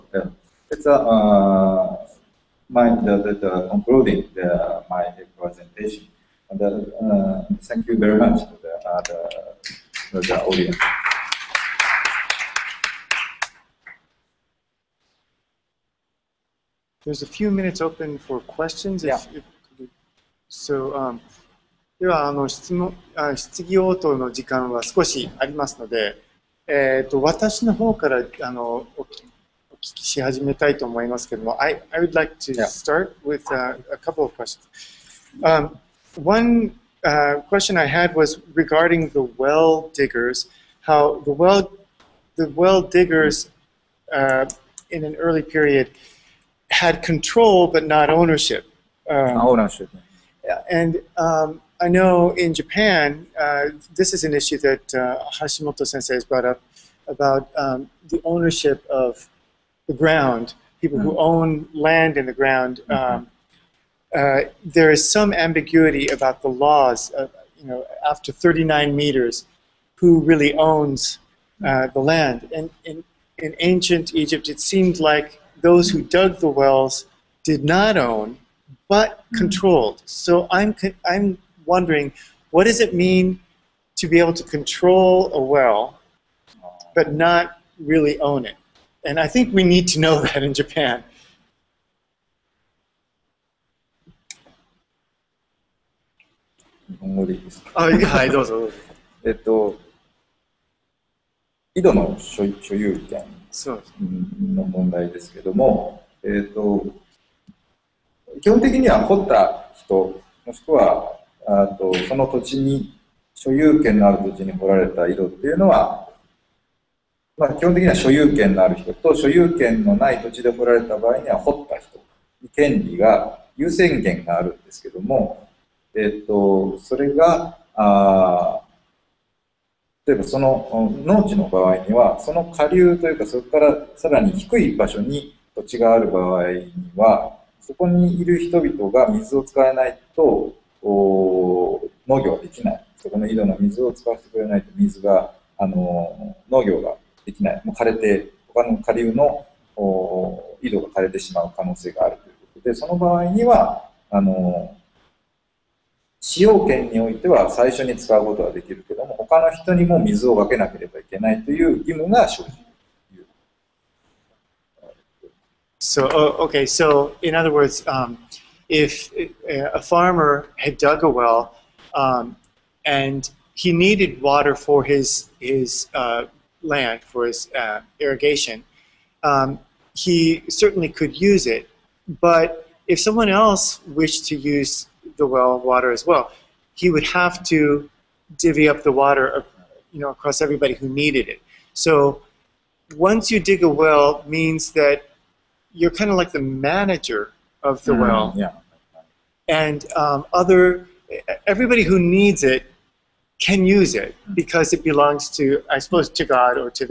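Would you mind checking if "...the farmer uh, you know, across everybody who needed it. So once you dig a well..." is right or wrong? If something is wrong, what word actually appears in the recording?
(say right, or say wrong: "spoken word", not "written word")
wrong: "water", not "farmer".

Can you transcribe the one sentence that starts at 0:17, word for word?
There's a few minutes open for questions.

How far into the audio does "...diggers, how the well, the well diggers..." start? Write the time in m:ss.
0:39.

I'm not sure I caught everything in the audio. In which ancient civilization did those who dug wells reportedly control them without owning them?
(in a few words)
ancient Egypt.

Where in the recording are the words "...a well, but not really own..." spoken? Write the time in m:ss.
1:25.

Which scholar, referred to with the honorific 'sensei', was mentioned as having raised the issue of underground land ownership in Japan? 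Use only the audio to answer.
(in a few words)
Hashimoto.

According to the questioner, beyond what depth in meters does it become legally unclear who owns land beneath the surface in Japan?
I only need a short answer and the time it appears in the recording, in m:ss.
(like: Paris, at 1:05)
39 meters, at 1:08.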